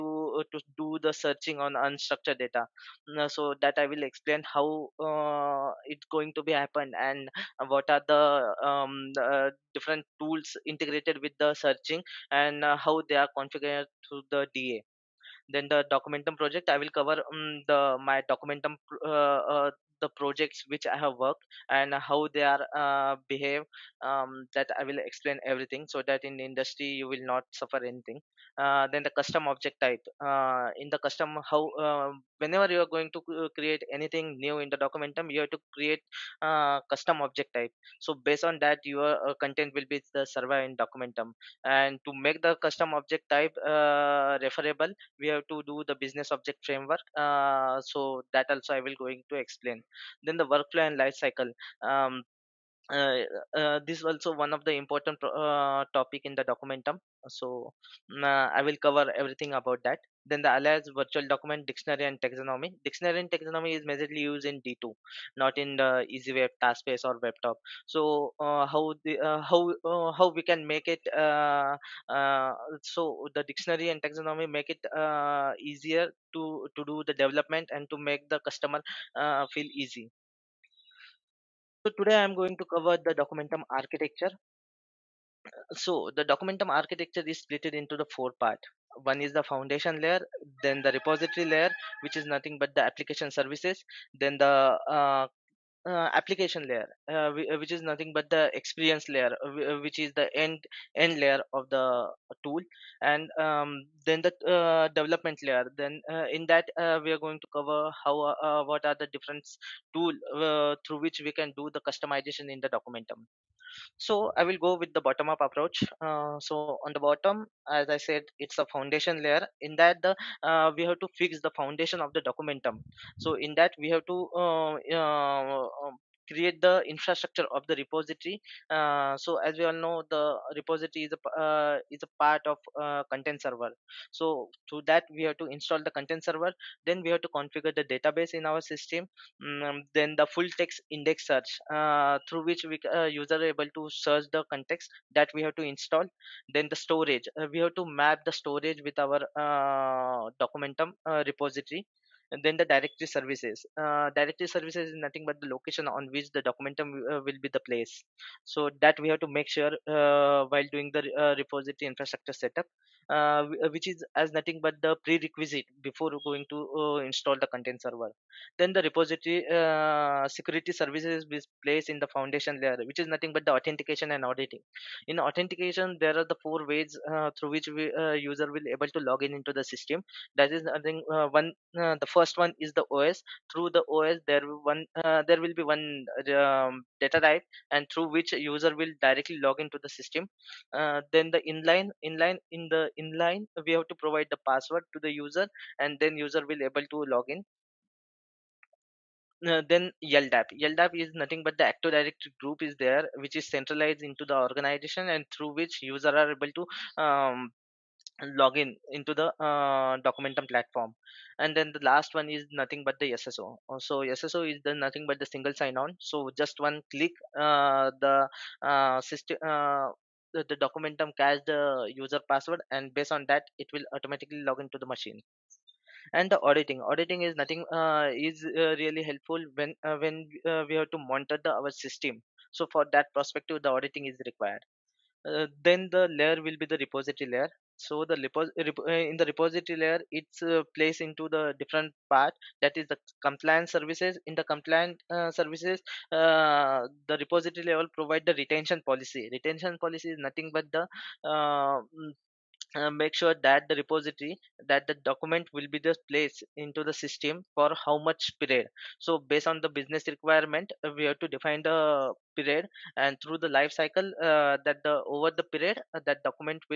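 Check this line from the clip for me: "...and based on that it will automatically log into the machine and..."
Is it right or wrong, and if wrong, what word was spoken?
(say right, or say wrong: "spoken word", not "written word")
right.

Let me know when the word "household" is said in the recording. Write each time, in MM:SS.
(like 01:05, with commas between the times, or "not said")
not said.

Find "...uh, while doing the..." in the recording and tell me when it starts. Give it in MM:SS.
02:39.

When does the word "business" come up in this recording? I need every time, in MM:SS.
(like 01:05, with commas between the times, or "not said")
00:45, 04:19.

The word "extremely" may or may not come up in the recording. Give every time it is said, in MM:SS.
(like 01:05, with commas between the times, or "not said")
not said.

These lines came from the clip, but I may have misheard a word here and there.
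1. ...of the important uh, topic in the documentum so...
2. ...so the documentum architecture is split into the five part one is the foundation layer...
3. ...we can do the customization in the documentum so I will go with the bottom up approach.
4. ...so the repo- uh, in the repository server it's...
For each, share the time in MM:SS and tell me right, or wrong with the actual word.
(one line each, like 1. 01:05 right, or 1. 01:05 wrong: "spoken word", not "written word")
1. 00:54 right
2. 01:25 wrong: "four", not "five"
3. 01:51 right
4. 03:57 wrong: "layer", not "server".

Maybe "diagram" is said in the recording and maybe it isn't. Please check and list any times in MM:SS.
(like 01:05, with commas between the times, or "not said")
not said.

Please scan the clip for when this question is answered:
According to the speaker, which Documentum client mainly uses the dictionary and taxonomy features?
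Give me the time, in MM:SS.
01:04.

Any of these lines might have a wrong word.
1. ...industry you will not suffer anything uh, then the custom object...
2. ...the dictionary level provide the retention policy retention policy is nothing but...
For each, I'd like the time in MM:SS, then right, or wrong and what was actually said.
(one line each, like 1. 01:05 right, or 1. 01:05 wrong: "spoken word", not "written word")
1. 00:26 right
2. 04:07 wrong: "repository", not "dictionary".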